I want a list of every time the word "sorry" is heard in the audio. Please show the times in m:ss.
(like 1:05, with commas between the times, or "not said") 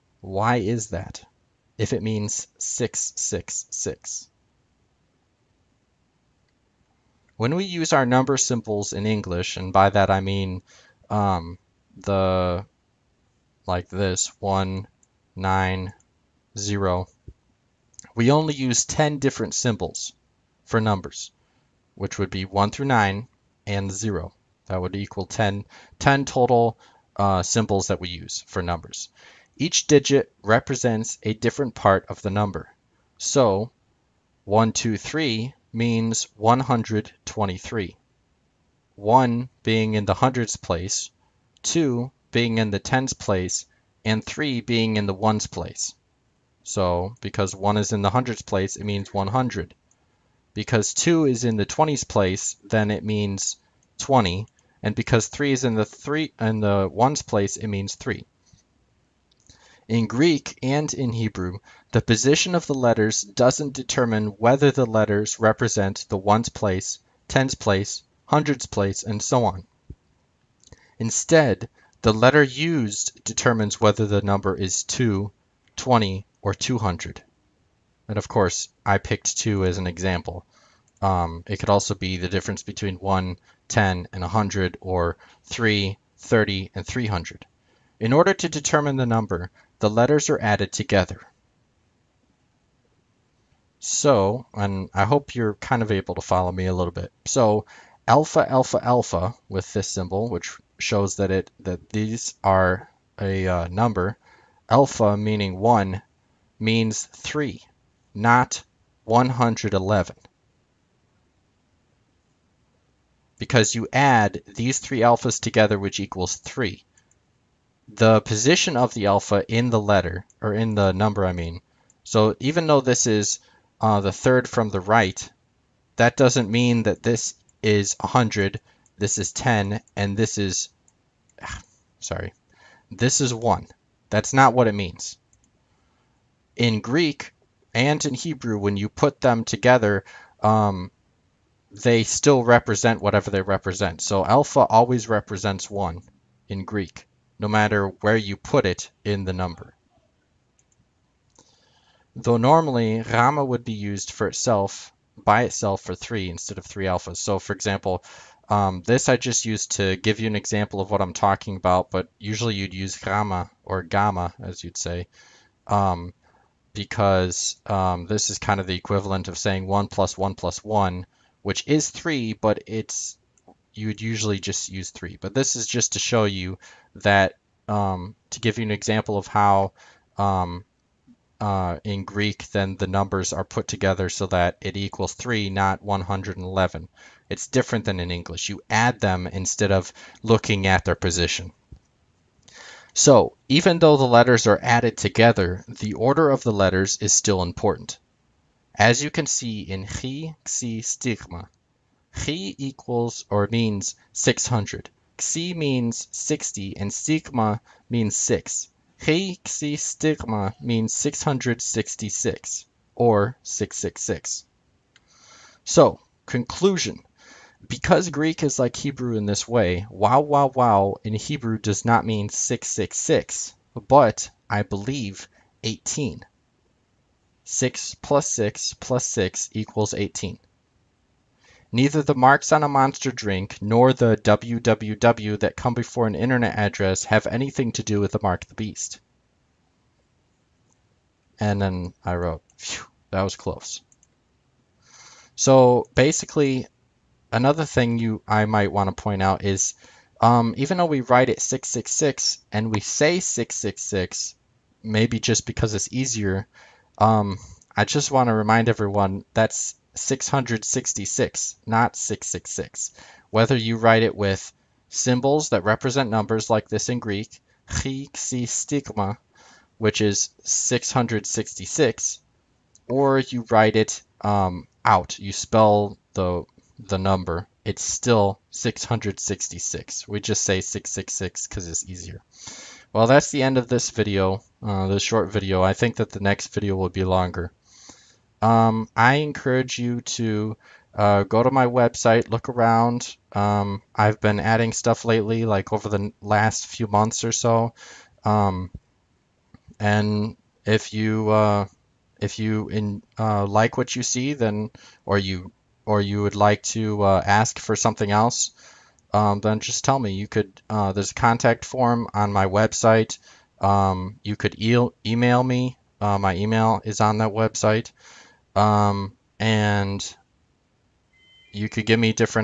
2:12.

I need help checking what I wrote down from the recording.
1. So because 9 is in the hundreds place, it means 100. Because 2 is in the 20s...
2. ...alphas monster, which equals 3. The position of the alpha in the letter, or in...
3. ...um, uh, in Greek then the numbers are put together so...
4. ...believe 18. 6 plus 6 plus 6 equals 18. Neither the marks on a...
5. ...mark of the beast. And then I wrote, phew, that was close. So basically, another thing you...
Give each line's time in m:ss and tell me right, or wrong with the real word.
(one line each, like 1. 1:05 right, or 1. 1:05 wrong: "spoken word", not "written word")
1. 0:46 wrong: "1", not "9"
2. 1:54 wrong: "together", not "monster"
3. 3:00 right
4. 3:44 right
5. 3:58 right.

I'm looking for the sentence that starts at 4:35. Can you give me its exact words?
You spell the the number, it's still 666.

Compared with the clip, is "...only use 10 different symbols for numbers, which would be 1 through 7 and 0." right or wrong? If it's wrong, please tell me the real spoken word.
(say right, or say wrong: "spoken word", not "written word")
wrong: "9", not "7".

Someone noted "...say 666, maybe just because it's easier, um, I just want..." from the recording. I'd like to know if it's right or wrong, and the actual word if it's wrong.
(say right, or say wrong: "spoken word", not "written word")
right.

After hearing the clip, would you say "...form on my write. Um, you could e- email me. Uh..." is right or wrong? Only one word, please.
wrong.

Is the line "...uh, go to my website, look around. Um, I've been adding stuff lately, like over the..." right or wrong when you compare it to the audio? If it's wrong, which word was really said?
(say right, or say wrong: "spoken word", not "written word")
right.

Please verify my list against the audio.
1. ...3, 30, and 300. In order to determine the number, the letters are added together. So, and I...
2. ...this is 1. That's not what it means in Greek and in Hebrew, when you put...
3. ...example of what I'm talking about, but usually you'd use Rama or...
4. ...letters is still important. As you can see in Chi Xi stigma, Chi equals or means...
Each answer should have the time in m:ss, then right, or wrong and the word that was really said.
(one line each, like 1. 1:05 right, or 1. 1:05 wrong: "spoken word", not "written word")
1. 1:25 right
2. 2:12 right
3. 2:40 right
4. 3:16 right.